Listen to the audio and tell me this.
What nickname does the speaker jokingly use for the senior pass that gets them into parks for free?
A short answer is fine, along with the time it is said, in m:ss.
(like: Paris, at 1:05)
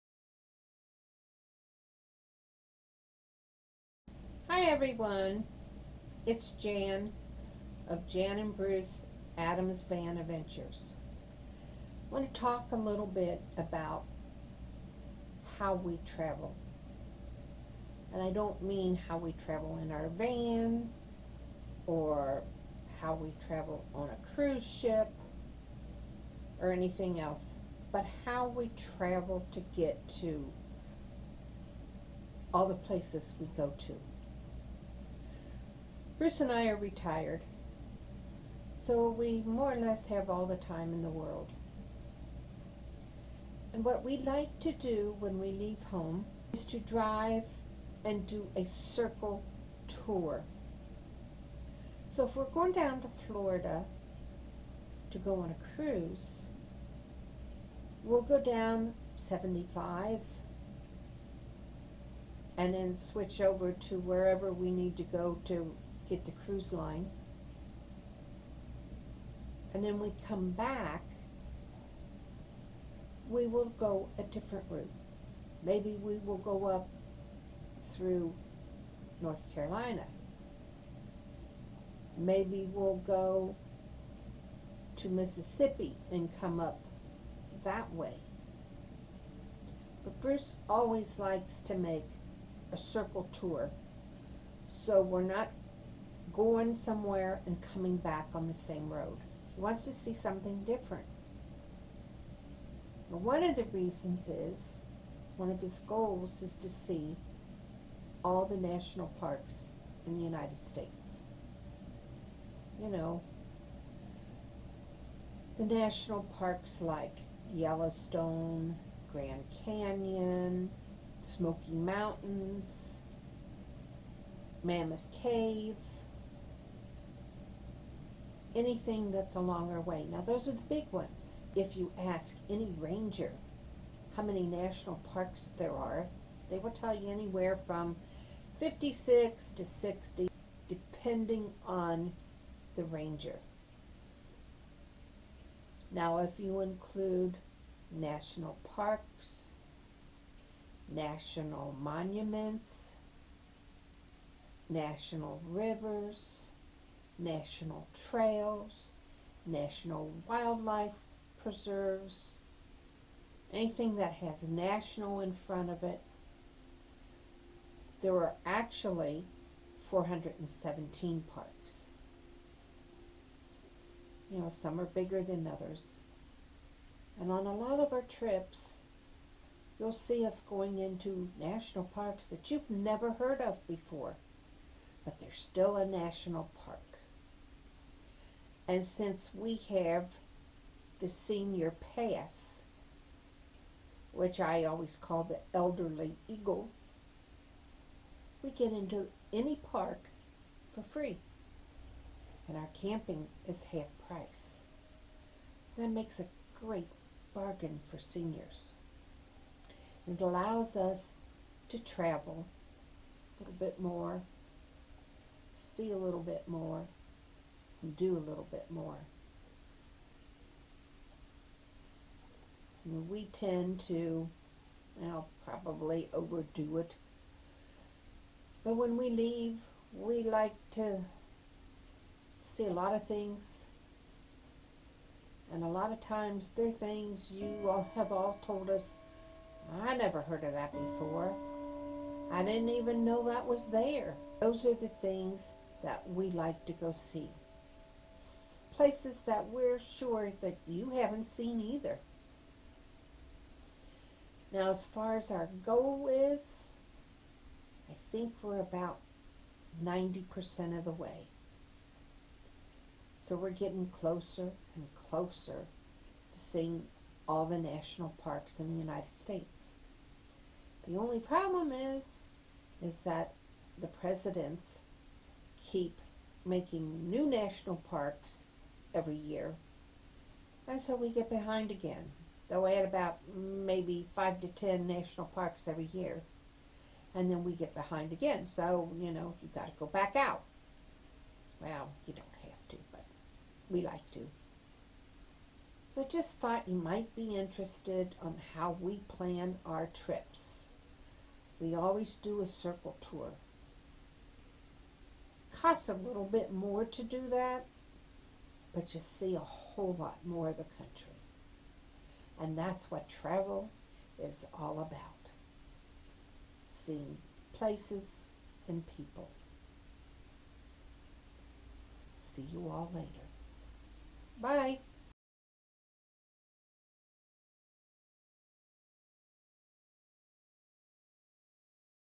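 elderly eagle, at 3:15.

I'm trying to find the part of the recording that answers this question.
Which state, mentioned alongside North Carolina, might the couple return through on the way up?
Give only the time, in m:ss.
1:25.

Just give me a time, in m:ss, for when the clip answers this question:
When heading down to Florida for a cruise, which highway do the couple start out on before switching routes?
0:59.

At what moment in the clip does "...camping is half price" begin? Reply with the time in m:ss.
3:22.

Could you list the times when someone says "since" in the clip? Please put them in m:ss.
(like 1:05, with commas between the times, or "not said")
3:08.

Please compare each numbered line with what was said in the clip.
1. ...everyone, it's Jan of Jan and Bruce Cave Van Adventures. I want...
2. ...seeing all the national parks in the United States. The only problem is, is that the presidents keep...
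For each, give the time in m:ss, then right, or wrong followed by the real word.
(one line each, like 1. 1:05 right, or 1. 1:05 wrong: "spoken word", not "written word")
1. 0:04 wrong: "Adams", not "Cave"
2. 4:26 right.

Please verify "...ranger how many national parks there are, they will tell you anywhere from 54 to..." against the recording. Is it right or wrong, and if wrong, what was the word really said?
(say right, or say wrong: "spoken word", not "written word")
wrong: "56", not "54".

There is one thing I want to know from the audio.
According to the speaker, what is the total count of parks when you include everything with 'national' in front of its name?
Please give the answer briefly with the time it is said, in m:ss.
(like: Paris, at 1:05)
417, at 2:49.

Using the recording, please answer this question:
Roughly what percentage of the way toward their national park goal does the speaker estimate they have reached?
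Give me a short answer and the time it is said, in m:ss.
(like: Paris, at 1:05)
90%, at 4:19.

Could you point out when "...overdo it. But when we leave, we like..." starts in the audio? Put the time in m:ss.
3:46.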